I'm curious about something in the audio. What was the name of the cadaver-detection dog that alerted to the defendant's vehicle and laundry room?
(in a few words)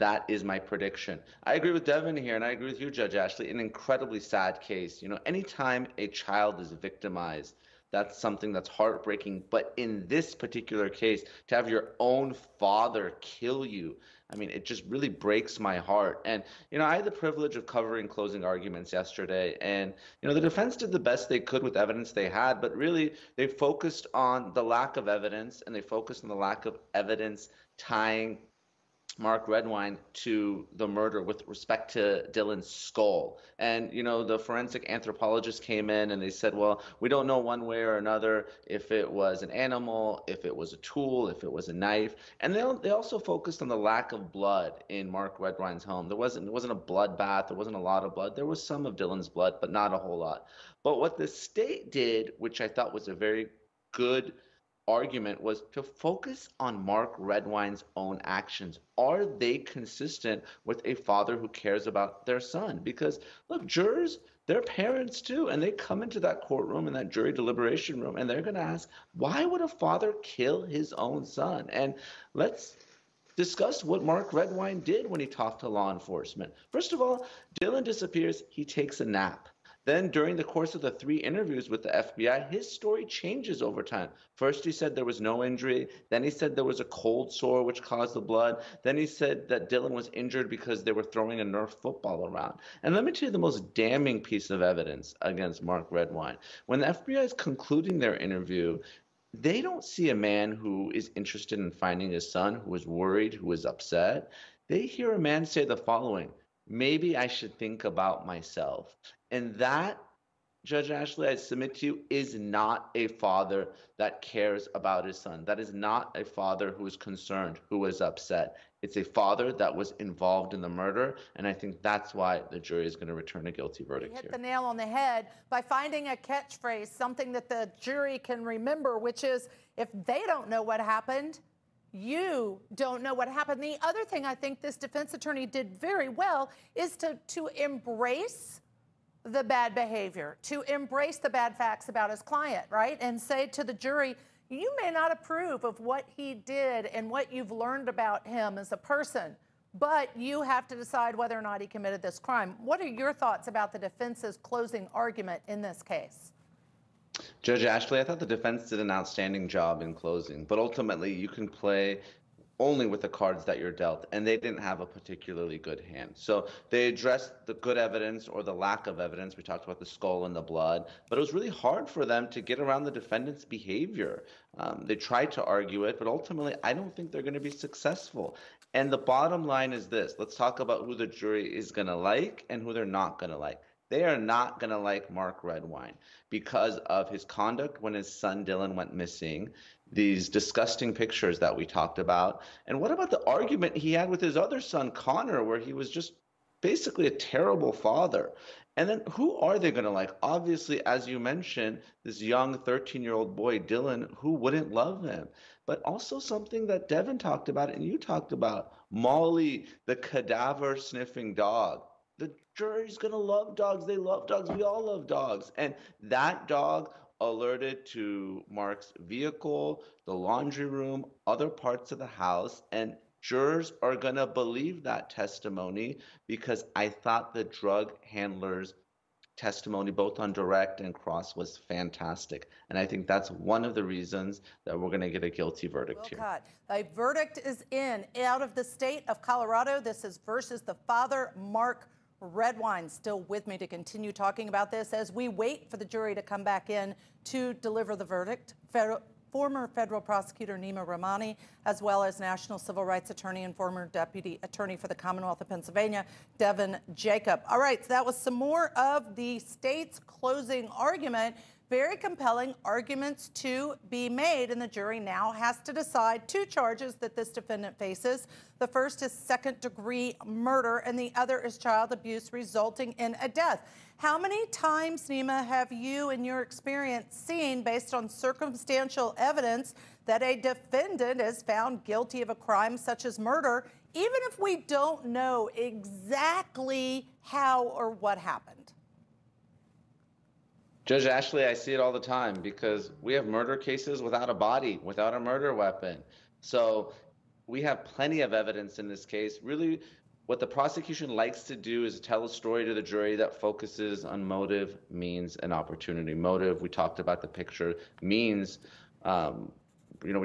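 Molly.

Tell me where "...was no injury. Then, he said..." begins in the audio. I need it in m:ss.
1:25.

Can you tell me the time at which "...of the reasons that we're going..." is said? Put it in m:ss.
3:53.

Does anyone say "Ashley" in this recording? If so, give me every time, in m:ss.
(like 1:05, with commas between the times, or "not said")
0:03, 1:50, 2:37, 4:51.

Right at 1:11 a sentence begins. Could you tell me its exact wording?
And let's discuss what Mark Redwine did when he talked to law enforcement.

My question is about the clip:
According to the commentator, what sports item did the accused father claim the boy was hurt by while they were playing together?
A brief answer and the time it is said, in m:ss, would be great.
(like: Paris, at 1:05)
Nerf football, at 1:31.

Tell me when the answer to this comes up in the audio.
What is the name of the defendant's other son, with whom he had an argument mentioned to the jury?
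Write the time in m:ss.
3:14.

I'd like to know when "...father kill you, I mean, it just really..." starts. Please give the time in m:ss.
0:12.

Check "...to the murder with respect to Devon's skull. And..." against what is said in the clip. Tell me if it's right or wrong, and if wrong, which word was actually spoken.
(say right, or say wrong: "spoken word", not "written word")
wrong: "Dylan", not "Devon".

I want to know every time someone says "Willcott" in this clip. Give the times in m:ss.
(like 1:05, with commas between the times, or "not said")
3:56.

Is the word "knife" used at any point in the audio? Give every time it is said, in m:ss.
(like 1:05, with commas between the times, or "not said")
0:41.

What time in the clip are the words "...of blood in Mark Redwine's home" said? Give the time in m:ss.
0:44.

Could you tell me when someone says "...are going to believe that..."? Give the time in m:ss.
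3:43.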